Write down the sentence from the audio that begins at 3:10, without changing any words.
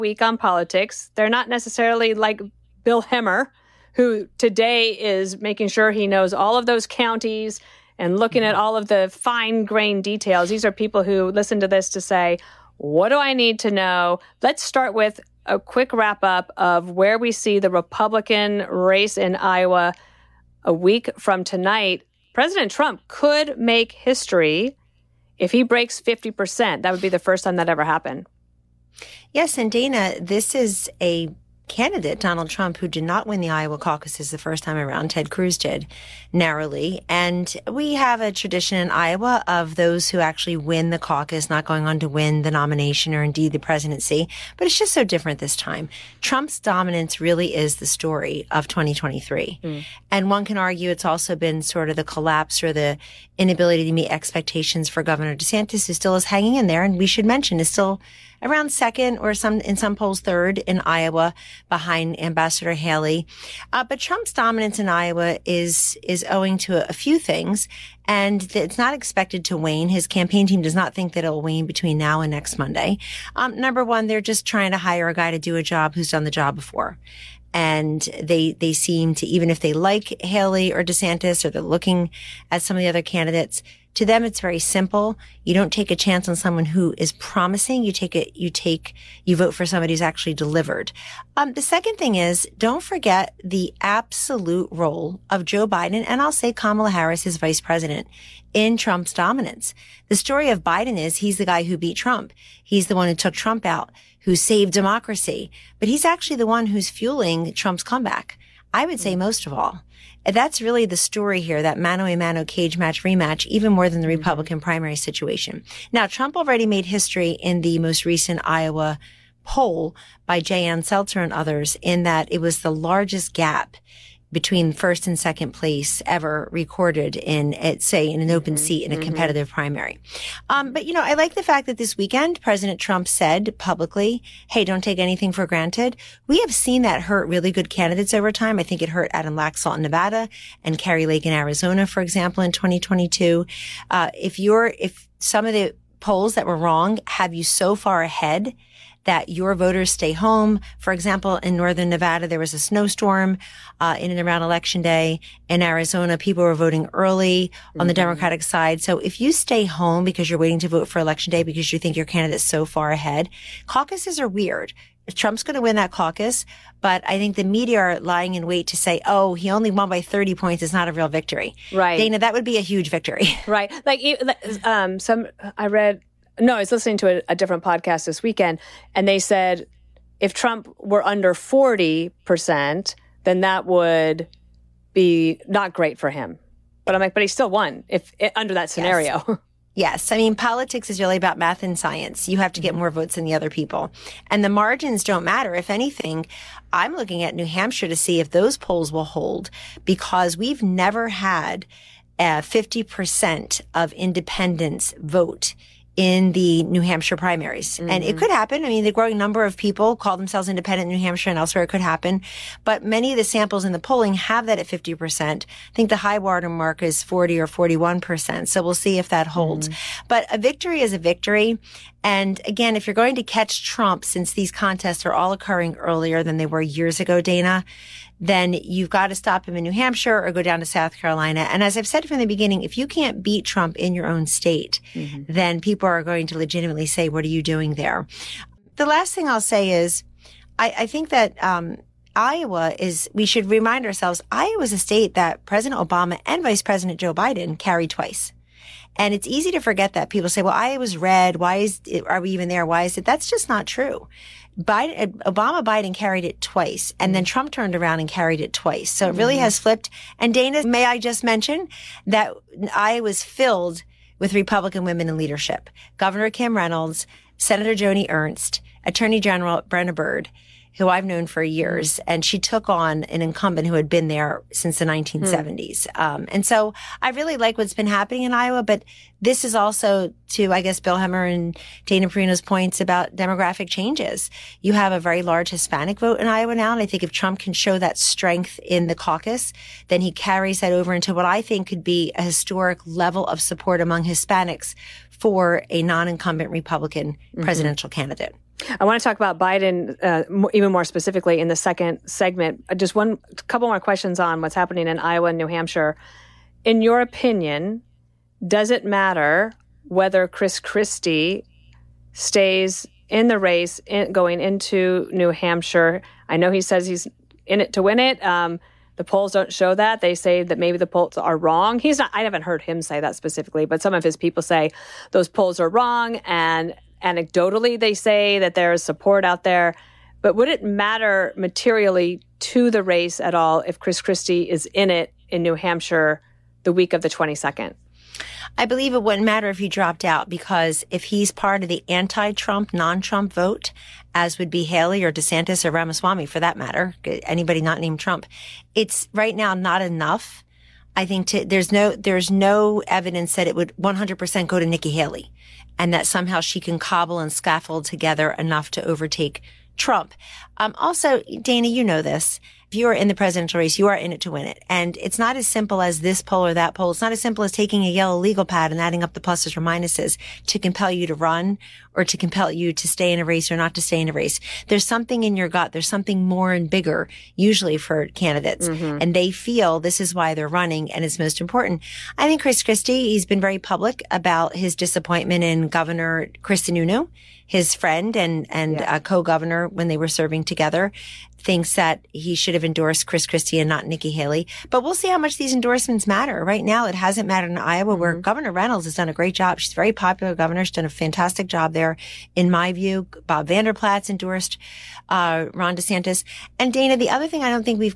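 I mean, politics is really about math and science.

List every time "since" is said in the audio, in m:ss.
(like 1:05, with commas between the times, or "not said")
3:44, 4:34.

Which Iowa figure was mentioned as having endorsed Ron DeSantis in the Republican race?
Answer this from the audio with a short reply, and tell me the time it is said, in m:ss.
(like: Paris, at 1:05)
Bob Vander Plaats, at 6:43.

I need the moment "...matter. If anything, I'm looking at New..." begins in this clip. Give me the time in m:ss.
3:15.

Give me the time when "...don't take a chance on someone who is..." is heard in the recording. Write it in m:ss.
1:25.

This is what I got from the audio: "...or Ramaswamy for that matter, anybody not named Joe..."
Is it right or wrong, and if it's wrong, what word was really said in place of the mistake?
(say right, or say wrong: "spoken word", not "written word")
wrong: "Trump", not "Joe".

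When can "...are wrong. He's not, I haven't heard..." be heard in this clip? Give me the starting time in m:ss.
5:21.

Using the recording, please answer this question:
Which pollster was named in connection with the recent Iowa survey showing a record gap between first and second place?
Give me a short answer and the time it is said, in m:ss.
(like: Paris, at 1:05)
J. Ann Selzer, at 2:00.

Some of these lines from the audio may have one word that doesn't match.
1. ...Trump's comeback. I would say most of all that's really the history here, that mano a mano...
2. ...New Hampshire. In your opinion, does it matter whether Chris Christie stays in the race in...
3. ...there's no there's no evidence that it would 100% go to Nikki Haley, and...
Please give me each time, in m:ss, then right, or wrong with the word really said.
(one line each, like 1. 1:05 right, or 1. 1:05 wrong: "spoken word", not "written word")
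1. 1:47 wrong: "story", not "history"
2. 5:05 right
3. 5:51 right.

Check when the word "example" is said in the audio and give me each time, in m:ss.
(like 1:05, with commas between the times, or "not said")
2:22, 2:30.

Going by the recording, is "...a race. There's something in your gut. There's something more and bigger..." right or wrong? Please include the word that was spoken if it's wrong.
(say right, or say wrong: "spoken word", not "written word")
right.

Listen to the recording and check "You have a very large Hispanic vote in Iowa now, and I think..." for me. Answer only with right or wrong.
right.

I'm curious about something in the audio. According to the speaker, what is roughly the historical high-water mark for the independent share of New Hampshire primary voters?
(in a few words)
40 or 41%.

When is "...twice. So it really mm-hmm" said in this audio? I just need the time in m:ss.
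4:18.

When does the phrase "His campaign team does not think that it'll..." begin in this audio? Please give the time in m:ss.
1:09.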